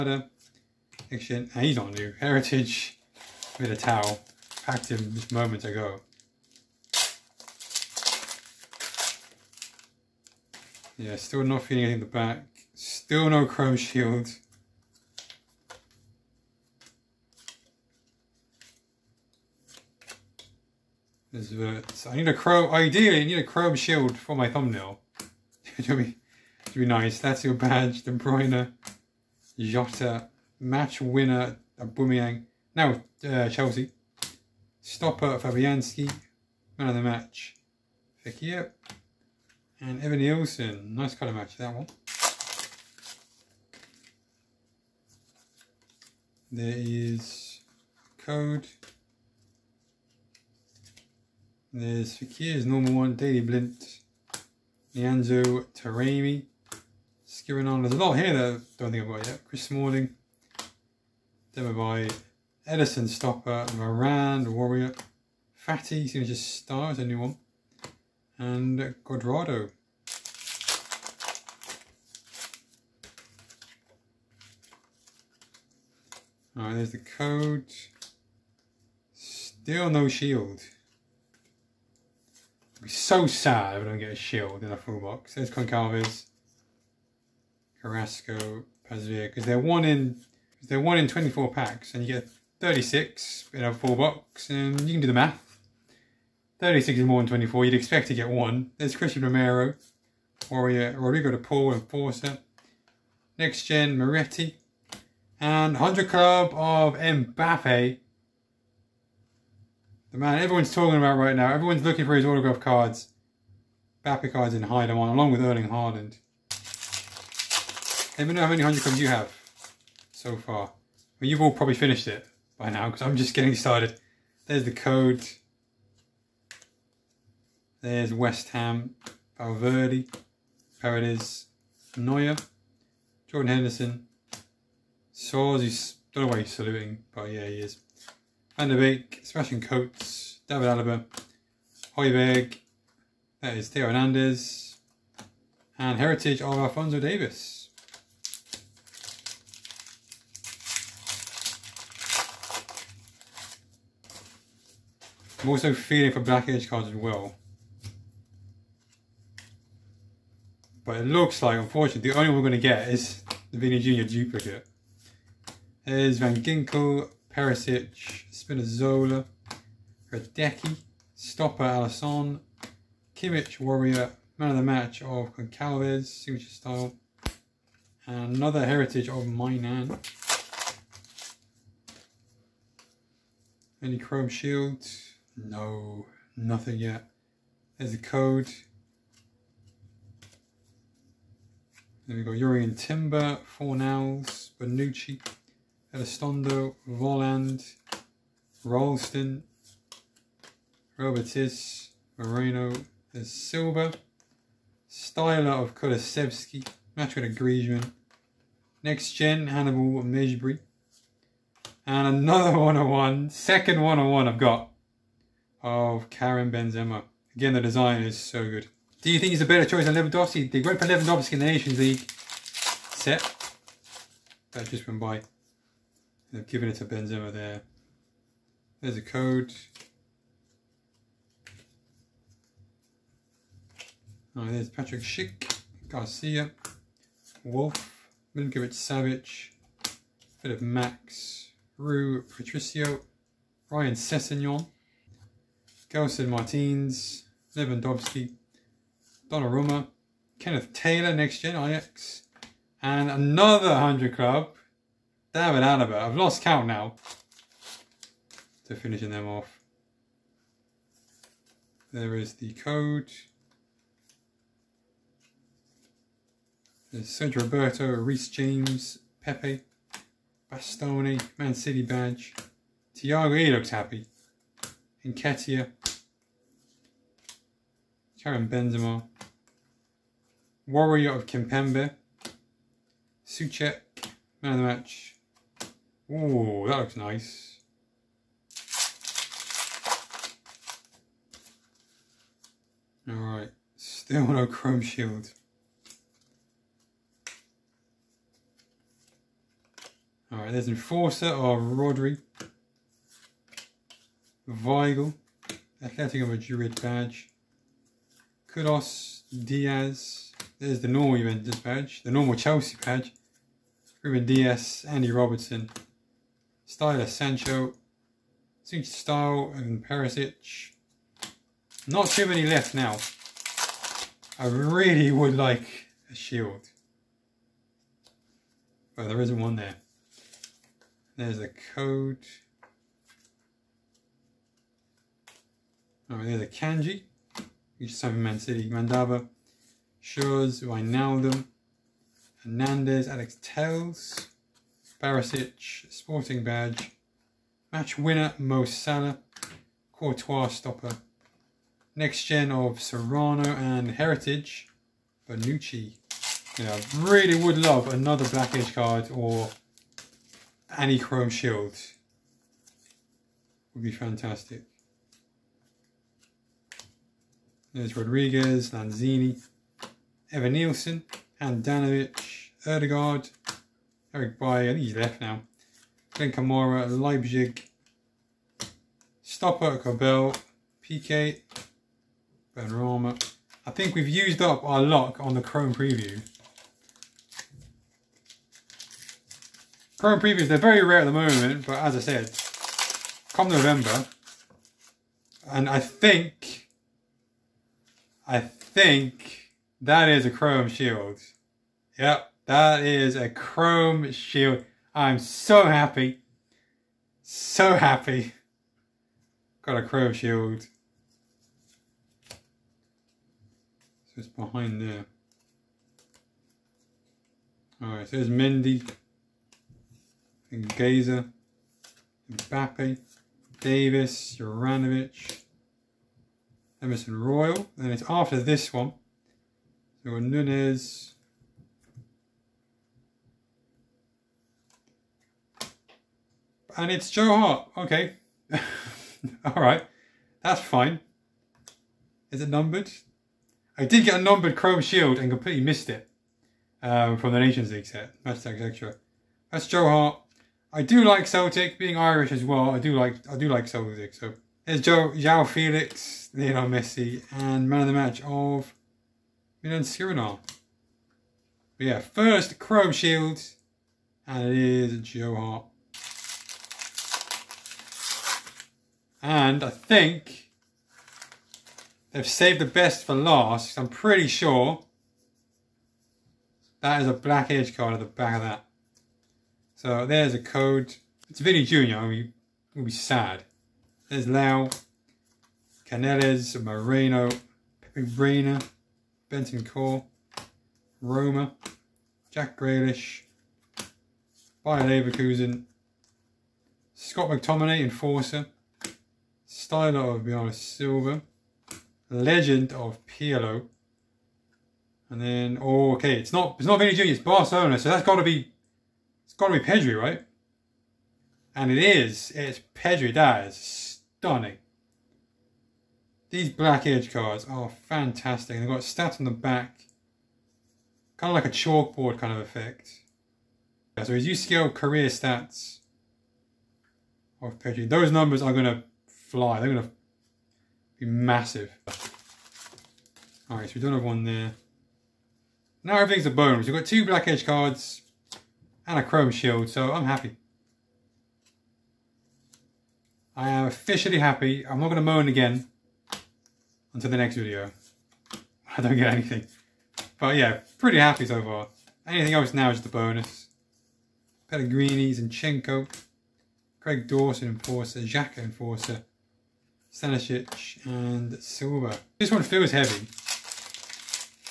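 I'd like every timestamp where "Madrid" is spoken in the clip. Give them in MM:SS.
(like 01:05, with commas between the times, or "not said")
05:06.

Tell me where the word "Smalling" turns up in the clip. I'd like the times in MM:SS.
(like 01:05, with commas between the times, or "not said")
00:59.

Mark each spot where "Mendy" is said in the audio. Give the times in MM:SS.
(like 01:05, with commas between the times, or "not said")
06:58.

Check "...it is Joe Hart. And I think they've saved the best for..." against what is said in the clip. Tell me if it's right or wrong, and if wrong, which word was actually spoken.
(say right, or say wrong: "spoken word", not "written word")
right.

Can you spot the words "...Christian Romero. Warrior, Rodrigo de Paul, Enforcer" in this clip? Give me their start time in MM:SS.
01:38.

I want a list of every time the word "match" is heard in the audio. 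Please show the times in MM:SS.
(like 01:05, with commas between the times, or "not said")
00:30, 00:37, 00:41, 02:54, 03:26, 04:44, 05:47, 07:37.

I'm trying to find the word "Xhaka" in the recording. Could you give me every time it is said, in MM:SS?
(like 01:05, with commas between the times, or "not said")
09:18.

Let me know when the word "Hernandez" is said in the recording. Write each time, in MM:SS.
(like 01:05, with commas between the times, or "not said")
02:23, 05:42.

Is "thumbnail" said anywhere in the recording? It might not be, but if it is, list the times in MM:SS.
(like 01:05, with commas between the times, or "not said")
00:24.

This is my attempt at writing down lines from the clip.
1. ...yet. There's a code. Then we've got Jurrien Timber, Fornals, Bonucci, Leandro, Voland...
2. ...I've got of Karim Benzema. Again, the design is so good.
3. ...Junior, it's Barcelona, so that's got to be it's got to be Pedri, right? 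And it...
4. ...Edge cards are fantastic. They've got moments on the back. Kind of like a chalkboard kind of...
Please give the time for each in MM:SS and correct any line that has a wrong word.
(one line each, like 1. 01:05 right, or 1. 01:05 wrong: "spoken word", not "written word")
1. 03:06 wrong: "Elistondo", not "Leandro"
2. 03:34 right
3. 08:26 right
4. 08:36 wrong: "stats", not "moments".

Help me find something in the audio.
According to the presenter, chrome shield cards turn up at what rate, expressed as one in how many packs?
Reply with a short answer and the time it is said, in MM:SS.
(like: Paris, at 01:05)
24, at 01:30.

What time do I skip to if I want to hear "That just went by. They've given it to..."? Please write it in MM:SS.
03:44.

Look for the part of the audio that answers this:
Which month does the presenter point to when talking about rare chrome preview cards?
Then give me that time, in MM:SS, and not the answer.
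06:33.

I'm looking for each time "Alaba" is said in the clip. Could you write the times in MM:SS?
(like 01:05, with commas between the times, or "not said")
02:20, 04:15.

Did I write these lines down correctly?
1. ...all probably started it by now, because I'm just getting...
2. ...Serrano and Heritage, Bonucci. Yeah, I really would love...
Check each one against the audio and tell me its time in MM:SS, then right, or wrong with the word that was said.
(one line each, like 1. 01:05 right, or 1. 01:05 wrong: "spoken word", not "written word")
1. 02:01 wrong: "finished", not "started"
2. 05:52 right.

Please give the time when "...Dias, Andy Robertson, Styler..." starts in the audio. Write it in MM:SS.
05:14.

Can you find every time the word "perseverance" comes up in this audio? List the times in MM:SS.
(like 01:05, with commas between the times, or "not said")
not said.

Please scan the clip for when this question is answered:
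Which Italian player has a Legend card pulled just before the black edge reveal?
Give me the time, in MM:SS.
08:23.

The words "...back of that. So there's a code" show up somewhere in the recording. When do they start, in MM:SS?
07:58.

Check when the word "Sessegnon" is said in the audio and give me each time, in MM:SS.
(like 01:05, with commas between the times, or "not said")
04:03.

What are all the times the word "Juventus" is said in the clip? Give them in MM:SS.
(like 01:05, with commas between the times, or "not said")
05:11.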